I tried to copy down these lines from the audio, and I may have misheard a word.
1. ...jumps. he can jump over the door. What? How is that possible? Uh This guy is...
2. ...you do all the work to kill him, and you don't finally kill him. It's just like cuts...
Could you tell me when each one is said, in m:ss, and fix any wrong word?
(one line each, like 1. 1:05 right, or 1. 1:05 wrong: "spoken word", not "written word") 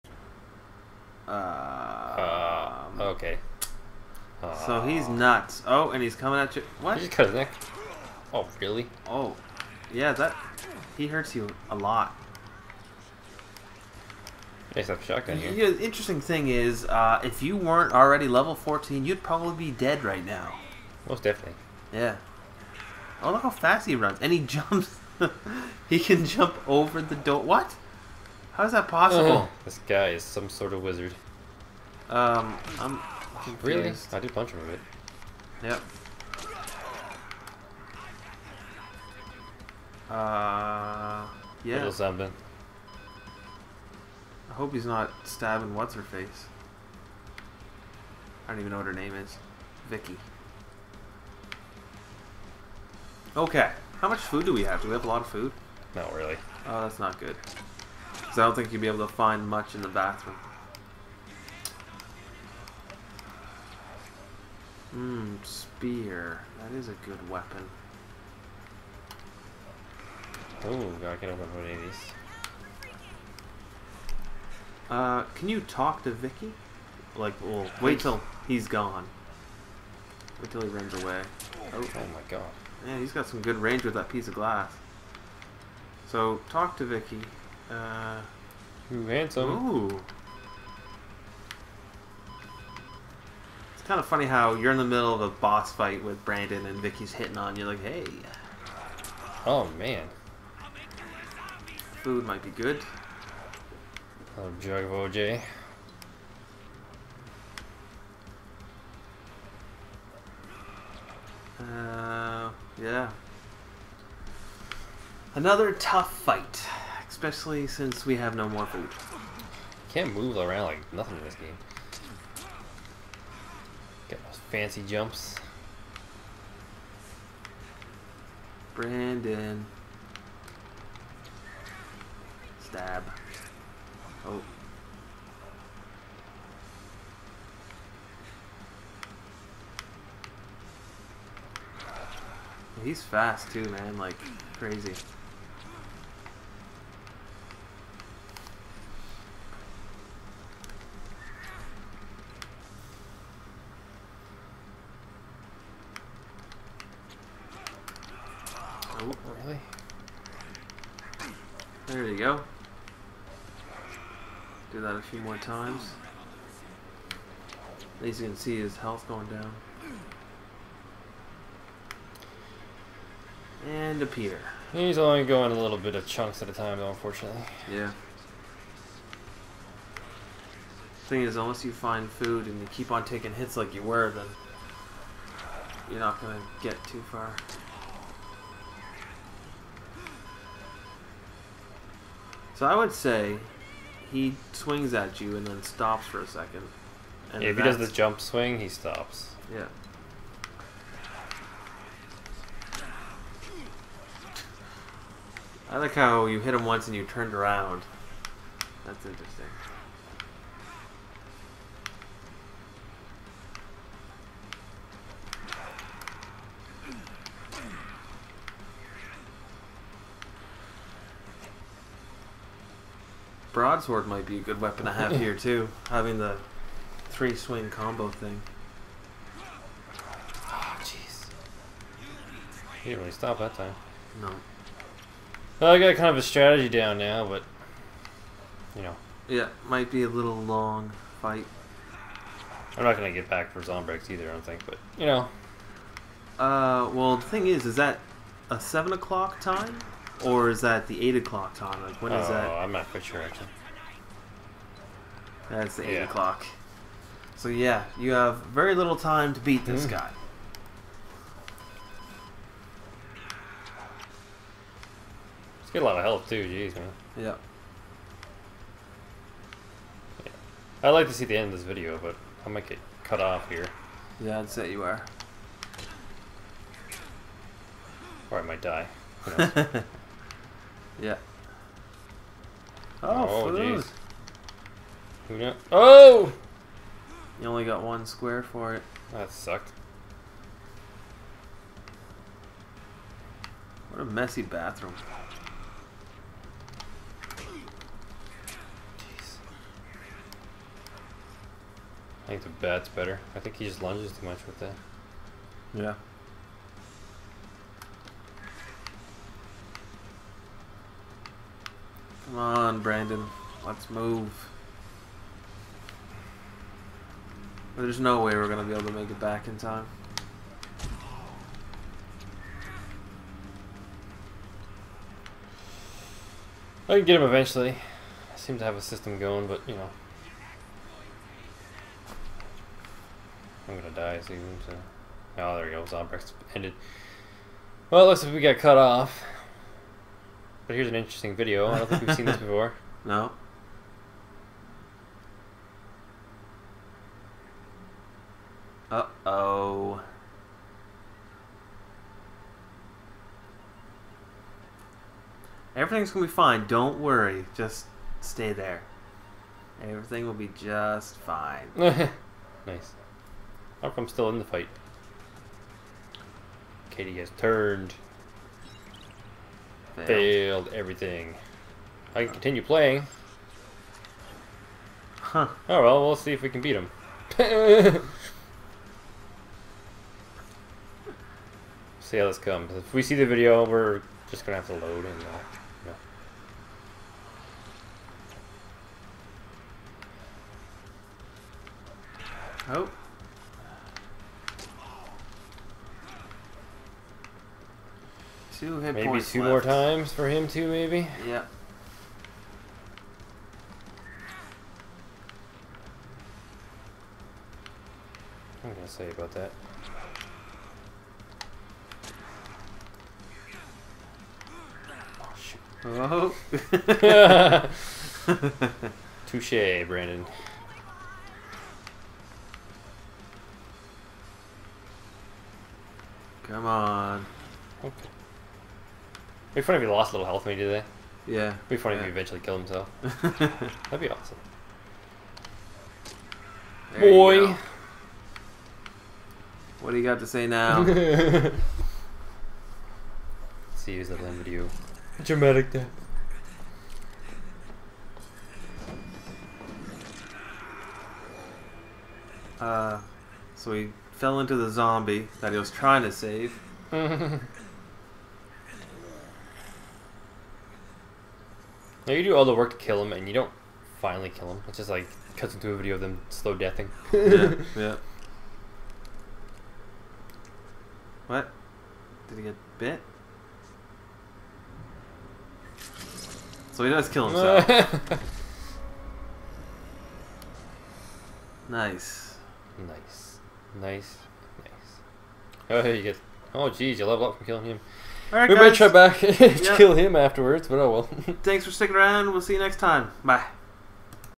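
1. 0:24 right
2. 7:42 right.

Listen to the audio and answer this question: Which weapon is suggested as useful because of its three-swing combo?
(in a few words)
Broadsword.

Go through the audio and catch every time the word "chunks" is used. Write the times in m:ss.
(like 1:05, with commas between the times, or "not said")
2:56.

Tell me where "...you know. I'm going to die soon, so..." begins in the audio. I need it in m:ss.
5:29.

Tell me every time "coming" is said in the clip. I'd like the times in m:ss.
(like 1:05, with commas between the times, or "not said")
0:06.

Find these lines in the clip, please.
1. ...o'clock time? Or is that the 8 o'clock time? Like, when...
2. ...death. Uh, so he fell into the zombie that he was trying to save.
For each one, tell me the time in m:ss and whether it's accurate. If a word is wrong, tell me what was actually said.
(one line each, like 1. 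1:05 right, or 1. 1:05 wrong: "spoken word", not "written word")
1. 4:08 right
2. 7:25 right.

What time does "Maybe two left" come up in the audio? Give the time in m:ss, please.
6:39.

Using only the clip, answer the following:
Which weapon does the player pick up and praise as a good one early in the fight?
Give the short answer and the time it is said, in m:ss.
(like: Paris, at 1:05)
Spear, at 1:05.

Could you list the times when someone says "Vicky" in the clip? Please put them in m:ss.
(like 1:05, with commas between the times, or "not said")
0:49, 1:16, 1:26, 1:36.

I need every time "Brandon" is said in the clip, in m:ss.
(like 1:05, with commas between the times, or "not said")
1:36, 2:08, 5:12, 6:59.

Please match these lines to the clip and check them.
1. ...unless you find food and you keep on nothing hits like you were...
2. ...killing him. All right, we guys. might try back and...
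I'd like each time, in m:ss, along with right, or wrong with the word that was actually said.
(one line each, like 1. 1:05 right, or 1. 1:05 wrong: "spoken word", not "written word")
1. 3:01 wrong: "taking", not "nothing"
2. 8:07 right.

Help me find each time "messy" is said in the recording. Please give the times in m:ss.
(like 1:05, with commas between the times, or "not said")
4:54.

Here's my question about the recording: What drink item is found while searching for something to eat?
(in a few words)
OJ.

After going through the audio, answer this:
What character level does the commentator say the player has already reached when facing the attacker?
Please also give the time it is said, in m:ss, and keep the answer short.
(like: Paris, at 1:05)
14, at 0:18.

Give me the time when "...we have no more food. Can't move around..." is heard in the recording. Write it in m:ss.
1:58.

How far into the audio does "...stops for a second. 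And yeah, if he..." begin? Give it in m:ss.
3:15.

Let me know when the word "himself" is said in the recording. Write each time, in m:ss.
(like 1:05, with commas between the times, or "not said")
7:12, 7:57.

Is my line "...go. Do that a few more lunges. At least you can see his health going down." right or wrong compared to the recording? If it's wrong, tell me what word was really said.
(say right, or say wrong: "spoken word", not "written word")
wrong: "times", not "lunges".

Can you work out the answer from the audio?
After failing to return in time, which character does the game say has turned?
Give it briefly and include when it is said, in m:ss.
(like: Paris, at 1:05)
Katey, at 6:06.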